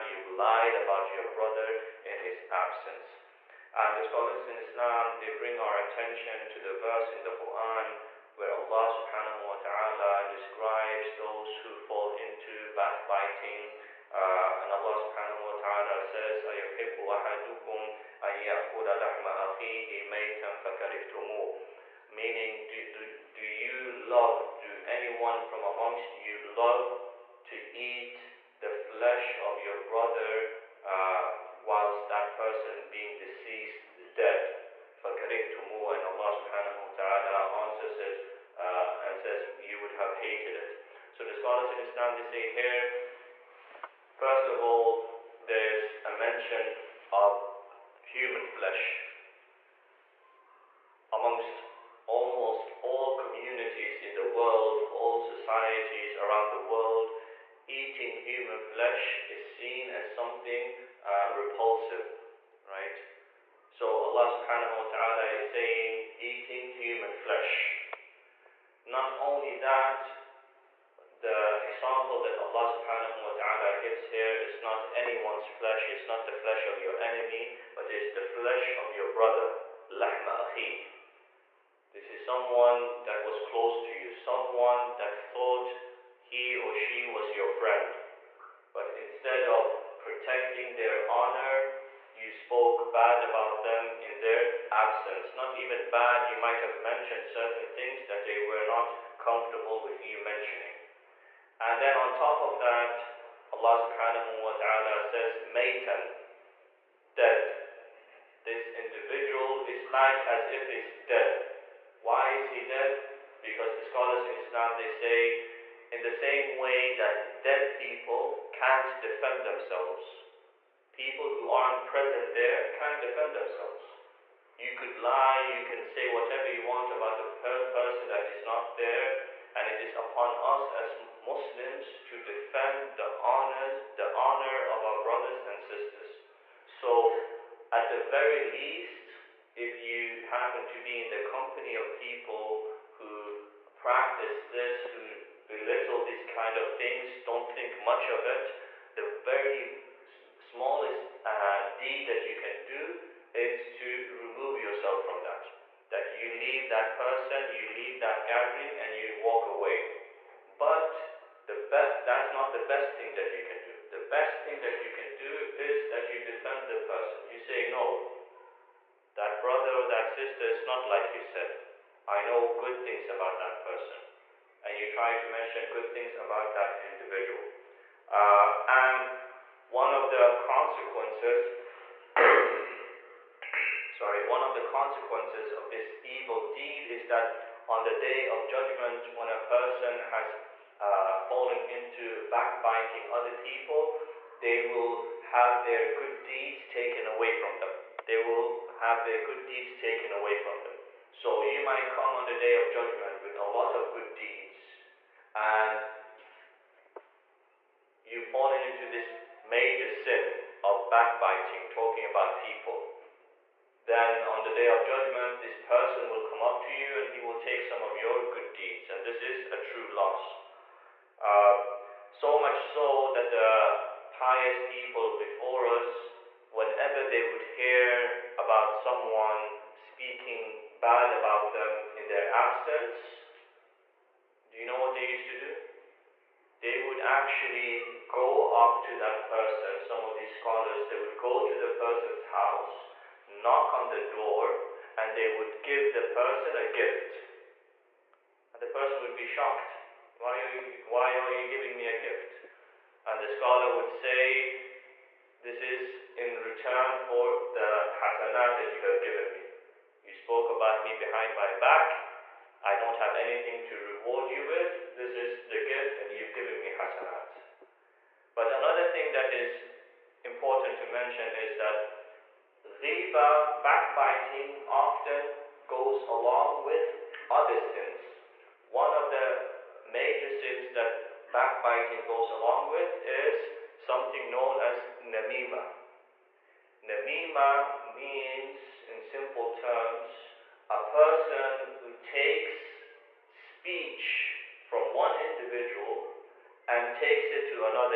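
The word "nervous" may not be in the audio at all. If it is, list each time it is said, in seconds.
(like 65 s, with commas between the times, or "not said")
not said.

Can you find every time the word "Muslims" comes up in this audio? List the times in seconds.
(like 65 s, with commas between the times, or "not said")
131 s.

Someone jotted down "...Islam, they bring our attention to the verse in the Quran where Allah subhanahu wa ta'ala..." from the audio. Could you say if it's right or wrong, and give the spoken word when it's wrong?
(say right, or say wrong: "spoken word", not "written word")
right.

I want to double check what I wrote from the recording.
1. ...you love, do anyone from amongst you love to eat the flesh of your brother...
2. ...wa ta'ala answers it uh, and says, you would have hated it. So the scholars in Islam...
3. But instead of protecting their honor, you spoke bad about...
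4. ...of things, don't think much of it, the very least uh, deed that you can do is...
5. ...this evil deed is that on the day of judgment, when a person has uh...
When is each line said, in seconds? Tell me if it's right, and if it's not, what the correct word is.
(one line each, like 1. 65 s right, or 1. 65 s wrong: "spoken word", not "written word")
1. 23 s right
2. 36 s right
3. 88 s right
4. 146 s wrong: "smallest", not "least"
5. 185 s right.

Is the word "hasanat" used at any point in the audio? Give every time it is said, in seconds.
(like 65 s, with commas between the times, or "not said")
257 s, 266 s.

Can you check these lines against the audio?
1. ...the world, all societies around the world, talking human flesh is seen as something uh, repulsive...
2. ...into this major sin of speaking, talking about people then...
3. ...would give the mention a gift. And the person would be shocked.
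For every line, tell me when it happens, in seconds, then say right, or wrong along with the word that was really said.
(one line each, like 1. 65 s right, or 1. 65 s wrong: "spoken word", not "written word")
1. 54 s wrong: "eating", not "talking"
2. 208 s wrong: "backbiting", not "speaking"
3. 245 s wrong: "person", not "mention".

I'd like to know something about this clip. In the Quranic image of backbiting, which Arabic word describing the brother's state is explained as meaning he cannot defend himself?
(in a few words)
Maitan.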